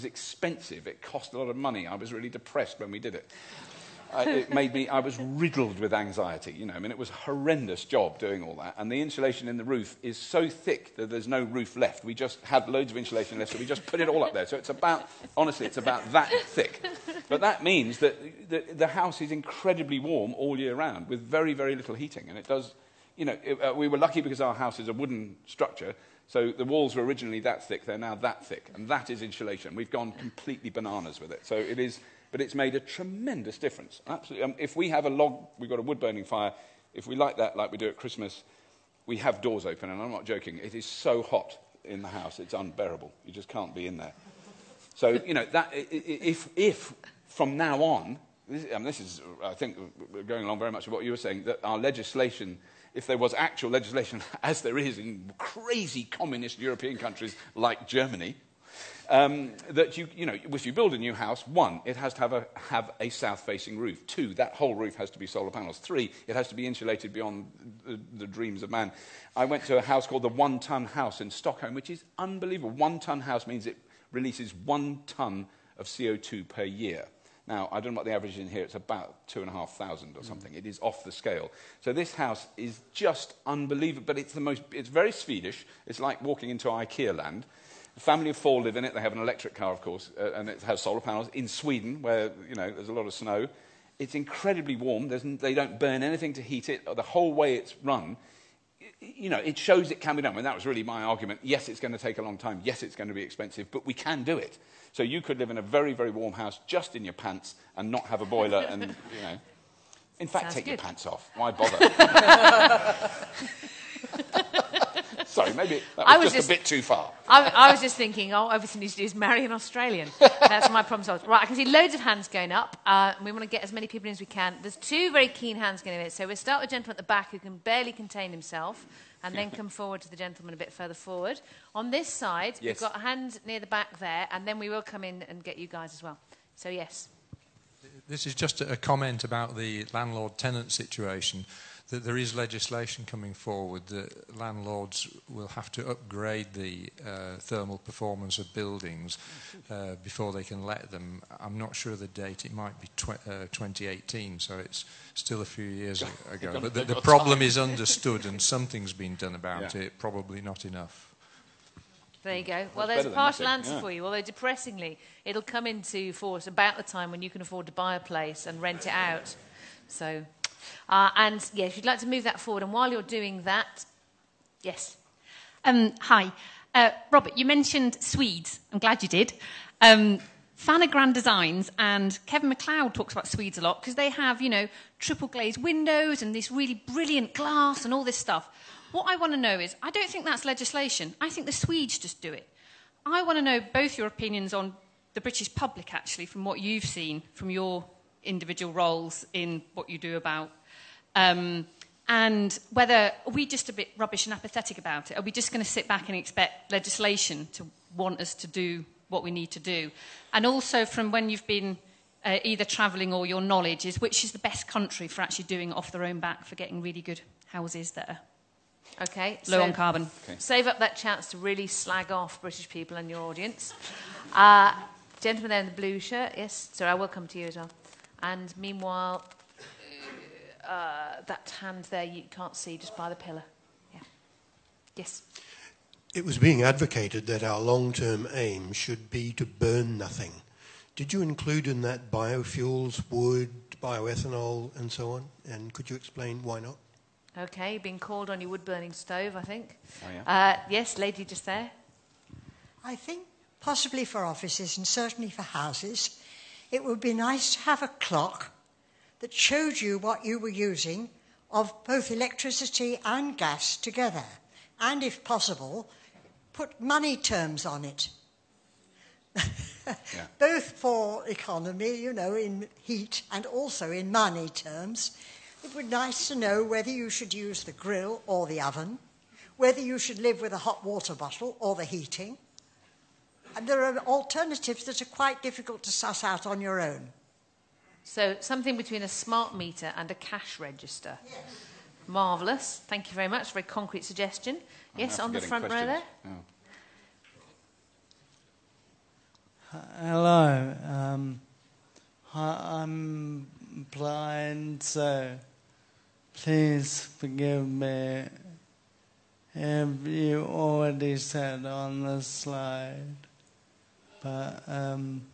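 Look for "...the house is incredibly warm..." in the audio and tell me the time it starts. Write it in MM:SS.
00:18.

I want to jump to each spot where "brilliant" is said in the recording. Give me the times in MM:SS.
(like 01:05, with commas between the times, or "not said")
03:06.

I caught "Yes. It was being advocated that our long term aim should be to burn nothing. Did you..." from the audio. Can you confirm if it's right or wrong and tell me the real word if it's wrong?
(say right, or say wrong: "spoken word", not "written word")
right.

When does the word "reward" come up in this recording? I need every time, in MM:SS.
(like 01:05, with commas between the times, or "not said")
not said.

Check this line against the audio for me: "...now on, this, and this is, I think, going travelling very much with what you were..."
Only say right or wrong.
wrong.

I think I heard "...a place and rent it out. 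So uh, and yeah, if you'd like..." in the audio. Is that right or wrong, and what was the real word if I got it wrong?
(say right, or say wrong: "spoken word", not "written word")
right.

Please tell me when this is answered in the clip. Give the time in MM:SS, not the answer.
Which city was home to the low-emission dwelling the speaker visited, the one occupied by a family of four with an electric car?
01:11.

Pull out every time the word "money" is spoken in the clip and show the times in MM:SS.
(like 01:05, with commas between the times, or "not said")
00:01, 04:26, 04:34.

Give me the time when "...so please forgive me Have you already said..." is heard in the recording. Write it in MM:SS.
05:04.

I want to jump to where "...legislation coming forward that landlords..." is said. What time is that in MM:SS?
02:22.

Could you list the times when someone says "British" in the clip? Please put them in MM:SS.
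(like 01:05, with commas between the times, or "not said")
03:15, 03:42.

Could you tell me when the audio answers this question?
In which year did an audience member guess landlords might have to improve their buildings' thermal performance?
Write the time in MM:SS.
02:33.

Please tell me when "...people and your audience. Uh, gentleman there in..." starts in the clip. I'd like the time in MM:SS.
03:42.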